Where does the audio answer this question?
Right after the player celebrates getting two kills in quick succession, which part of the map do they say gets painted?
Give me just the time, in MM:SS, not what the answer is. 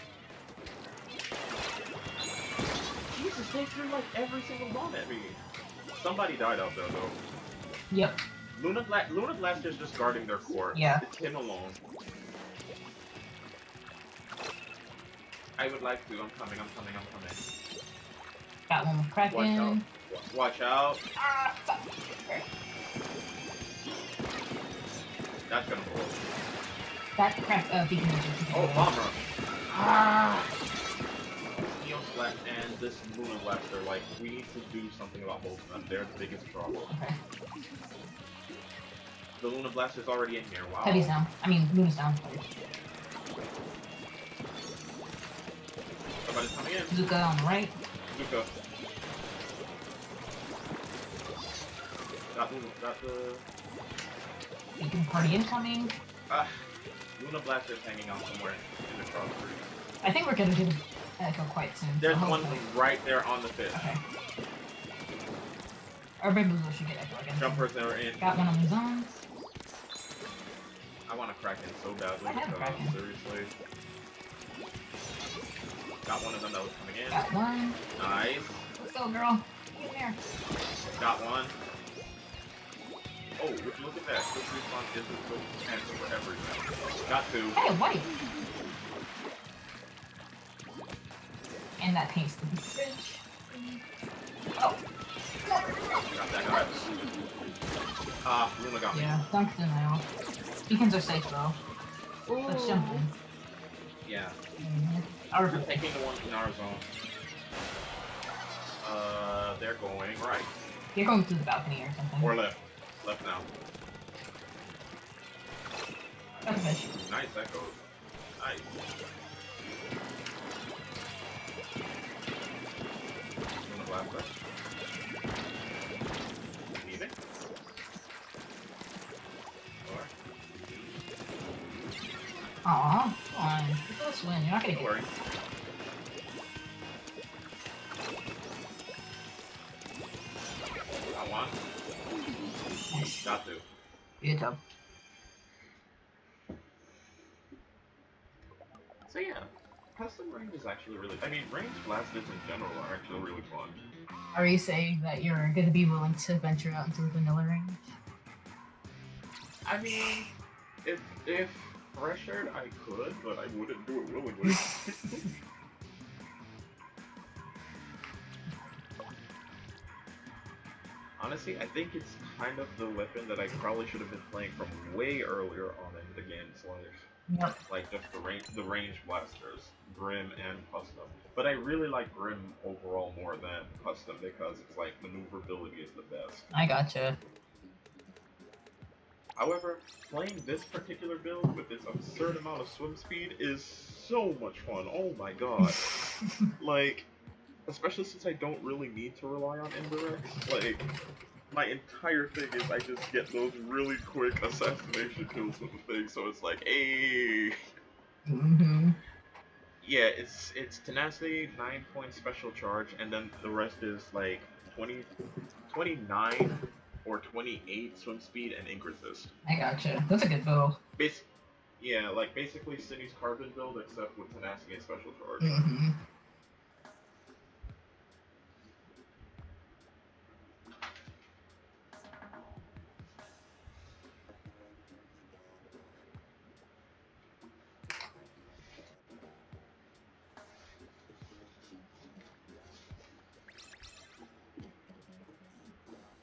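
01:32.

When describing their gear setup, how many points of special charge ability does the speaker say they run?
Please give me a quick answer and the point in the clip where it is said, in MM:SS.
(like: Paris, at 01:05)
9, at 03:31.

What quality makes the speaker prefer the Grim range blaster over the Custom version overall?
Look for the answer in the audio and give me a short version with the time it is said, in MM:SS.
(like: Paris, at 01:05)
maneuverability, at 03:05.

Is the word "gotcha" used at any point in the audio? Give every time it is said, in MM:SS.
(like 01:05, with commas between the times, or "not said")
03:06, 03:39.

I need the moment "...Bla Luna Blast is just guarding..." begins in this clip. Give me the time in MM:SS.
00:08.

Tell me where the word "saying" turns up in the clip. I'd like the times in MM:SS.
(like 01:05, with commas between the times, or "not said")
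02:34.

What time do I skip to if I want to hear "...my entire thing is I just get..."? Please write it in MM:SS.
03:21.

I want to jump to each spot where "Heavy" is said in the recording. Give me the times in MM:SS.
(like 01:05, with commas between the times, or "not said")
00:40.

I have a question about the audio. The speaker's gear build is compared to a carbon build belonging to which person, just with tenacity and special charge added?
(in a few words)
Cindy.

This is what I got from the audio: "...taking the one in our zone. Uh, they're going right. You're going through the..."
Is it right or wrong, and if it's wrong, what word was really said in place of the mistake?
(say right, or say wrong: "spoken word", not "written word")
right.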